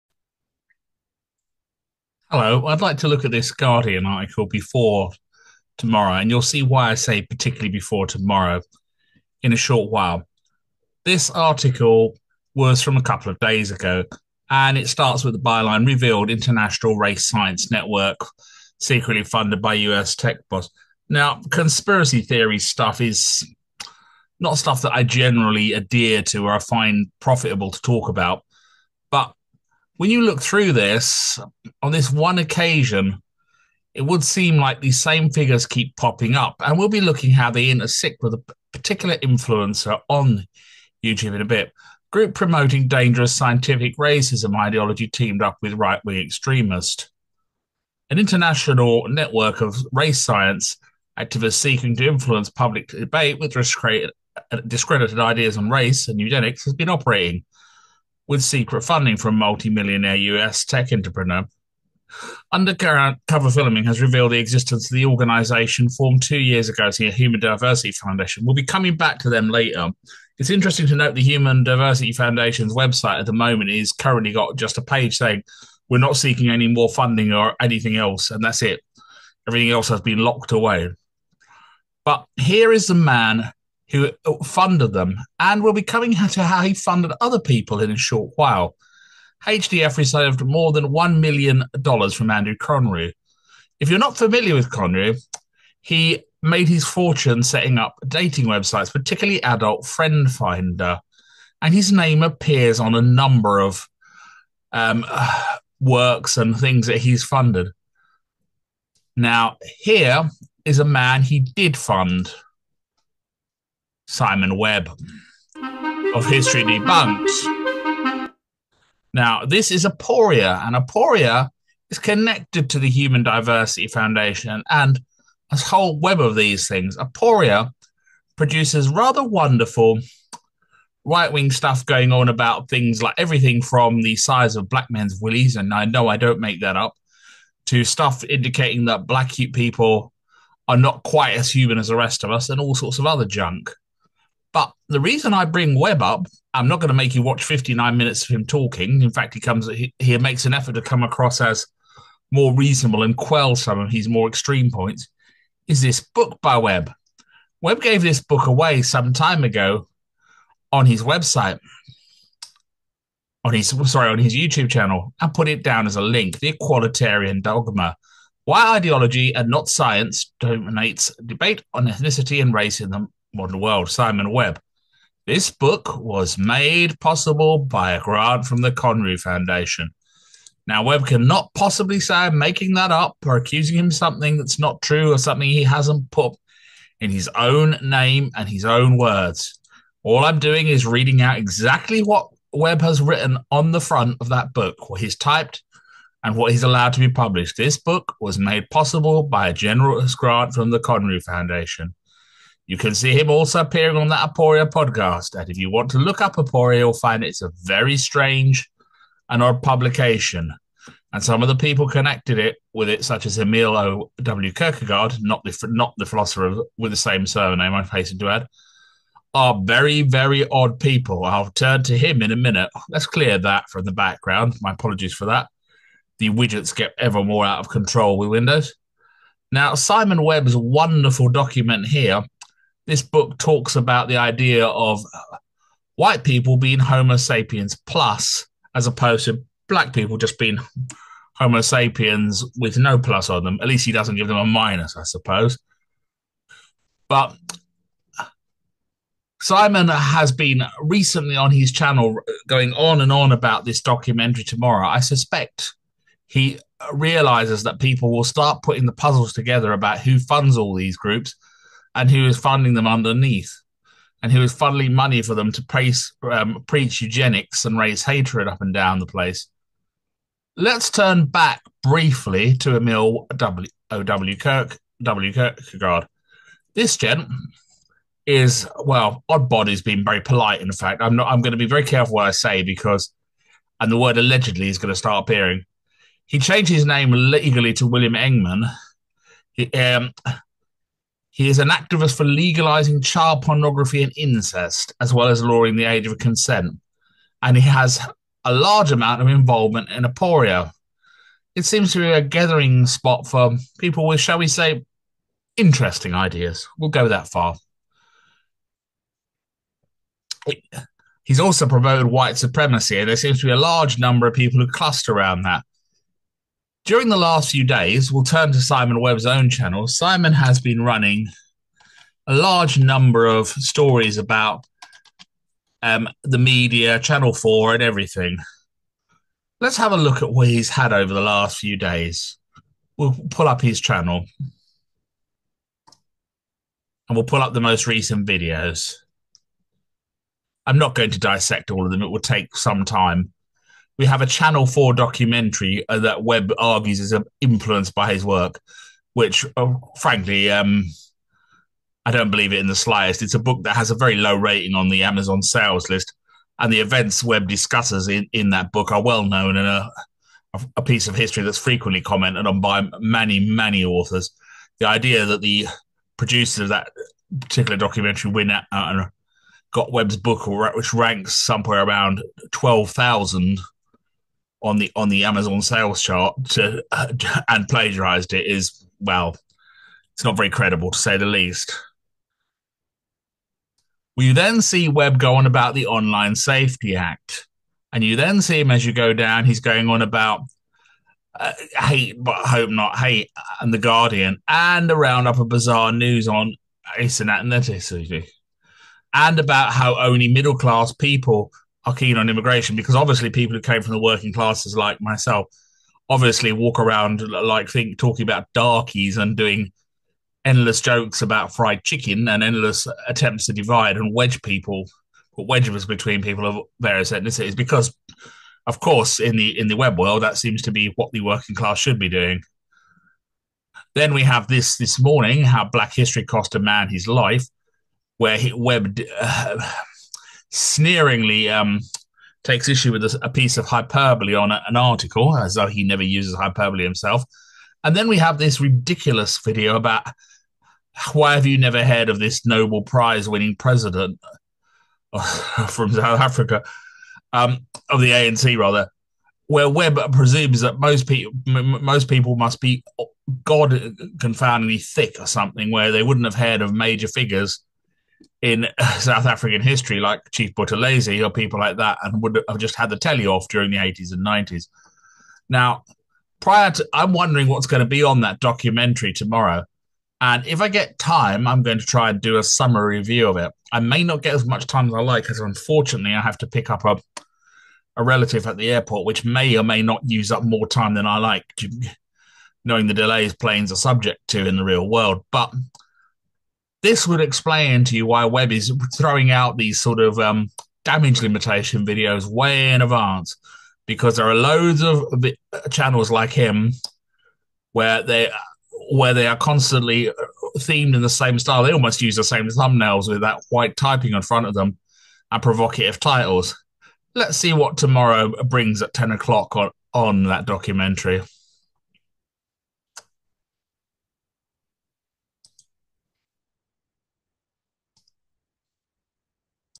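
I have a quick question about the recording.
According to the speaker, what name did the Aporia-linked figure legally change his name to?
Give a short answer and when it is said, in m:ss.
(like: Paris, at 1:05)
William Engman, at 4:47.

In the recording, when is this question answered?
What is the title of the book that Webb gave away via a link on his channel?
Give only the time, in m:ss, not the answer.
2:46.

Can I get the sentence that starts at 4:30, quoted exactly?
Let's turn back briefly to Emil W.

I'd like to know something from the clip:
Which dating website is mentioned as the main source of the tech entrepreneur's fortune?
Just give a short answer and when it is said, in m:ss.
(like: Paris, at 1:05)
Adult Friend Finder, at 1:39.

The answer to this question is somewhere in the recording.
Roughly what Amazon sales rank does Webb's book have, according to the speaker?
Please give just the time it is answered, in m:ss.
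6:12.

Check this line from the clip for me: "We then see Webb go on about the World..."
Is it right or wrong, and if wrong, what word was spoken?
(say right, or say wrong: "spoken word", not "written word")
wrong: "Online", not "World".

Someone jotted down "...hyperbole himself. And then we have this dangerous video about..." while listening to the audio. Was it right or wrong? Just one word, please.
wrong.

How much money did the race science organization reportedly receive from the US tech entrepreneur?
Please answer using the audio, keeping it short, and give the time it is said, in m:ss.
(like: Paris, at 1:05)
more than $1 million, at 1:30.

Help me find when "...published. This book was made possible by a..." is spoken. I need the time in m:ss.
3:17.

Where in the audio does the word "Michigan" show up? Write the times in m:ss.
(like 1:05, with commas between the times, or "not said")
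not said.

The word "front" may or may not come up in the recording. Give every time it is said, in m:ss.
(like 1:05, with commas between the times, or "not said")
3:13, 8:24.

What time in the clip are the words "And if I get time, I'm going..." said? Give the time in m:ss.
7:50.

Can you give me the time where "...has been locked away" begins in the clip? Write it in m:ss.
1:19.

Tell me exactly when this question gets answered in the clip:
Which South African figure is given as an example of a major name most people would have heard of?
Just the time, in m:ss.
7:40.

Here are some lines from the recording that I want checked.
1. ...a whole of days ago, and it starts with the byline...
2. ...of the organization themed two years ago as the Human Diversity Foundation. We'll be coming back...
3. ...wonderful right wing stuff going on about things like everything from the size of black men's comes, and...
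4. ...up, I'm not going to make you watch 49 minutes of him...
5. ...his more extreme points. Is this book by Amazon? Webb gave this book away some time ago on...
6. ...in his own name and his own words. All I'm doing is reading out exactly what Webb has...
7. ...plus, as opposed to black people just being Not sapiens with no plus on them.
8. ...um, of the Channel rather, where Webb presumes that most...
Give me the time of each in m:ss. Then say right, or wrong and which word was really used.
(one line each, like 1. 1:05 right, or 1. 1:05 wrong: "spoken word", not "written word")
1. 0:12 wrong: "couple", not "whole"
2. 1:04 wrong: "formed", not "themed"
3. 2:09 wrong: "willies", not "comes"
4. 2:26 wrong: "59", not "49"
5. 2:33 wrong: "Webb", not "Amazon"
6. 3:06 right
7. 3:57 wrong: "Homo", not "Not"
8. 7:27 wrong: "ANC", not "Channel".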